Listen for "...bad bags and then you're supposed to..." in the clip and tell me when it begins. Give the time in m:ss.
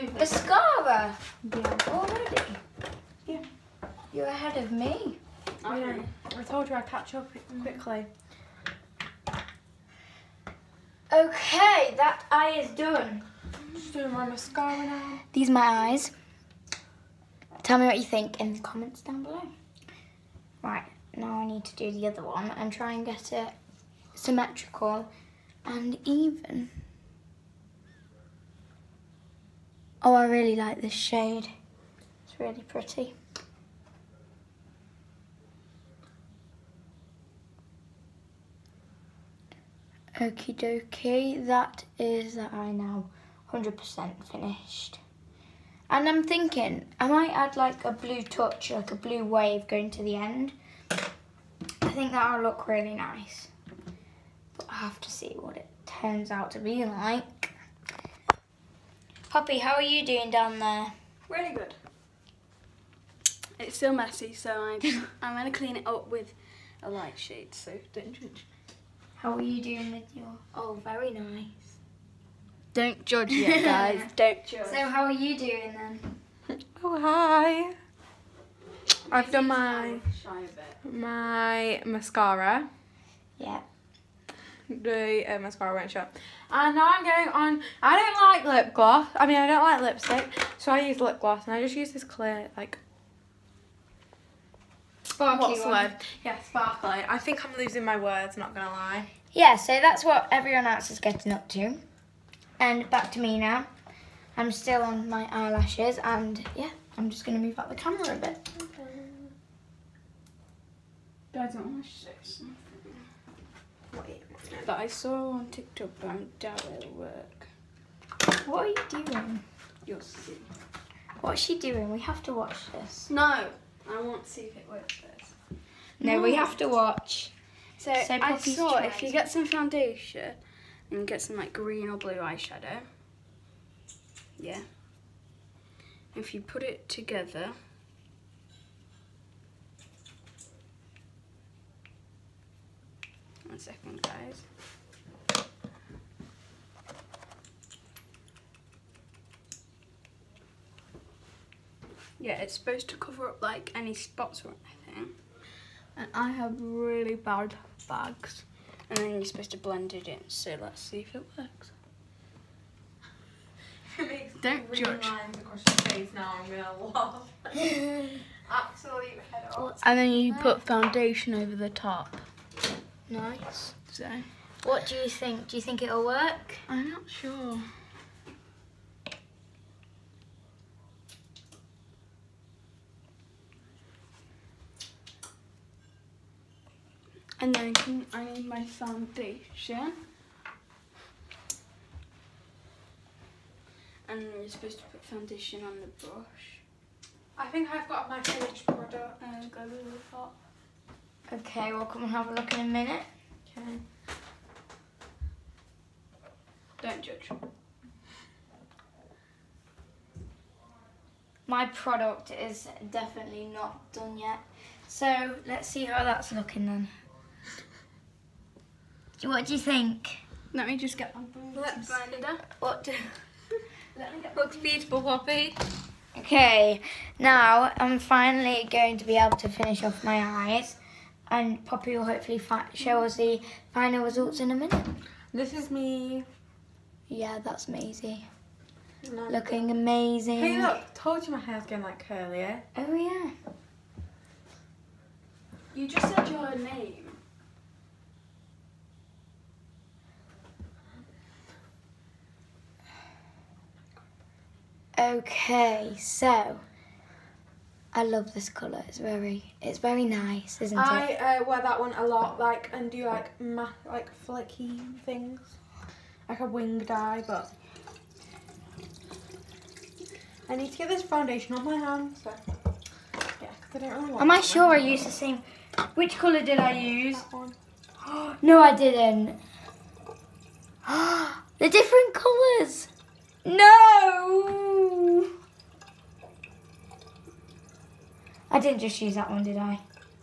2:37.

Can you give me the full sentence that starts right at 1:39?
Yeah, so that's what everyone else is getting up to.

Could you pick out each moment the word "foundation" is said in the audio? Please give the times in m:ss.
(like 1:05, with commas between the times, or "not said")
2:09, 2:50, 3:08, 3:15, 4:31.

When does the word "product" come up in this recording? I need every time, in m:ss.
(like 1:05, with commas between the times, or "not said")
3:18, 3:31.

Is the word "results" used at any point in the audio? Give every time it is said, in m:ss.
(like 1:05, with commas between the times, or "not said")
3:54.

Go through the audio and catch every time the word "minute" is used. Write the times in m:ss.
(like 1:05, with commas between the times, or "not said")
3:22, 3:54.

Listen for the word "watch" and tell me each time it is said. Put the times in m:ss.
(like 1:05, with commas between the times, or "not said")
2:02, 2:06.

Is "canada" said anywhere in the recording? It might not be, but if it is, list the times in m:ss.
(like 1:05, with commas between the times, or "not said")
not said.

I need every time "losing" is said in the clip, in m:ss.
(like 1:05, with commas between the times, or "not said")
1:37.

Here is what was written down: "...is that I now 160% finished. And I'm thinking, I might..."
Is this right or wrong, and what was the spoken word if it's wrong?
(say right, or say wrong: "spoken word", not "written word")
wrong: "100", not "160".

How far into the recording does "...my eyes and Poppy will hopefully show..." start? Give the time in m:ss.
3:50.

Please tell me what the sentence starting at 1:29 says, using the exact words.
I mean, I don't like lipstick, so I use lip gloss.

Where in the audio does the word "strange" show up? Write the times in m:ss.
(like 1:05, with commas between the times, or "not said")
not said.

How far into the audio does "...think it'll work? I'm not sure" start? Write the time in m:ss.
2:55.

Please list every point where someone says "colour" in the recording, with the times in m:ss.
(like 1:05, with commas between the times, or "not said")
4:18, 4:36, 4:42.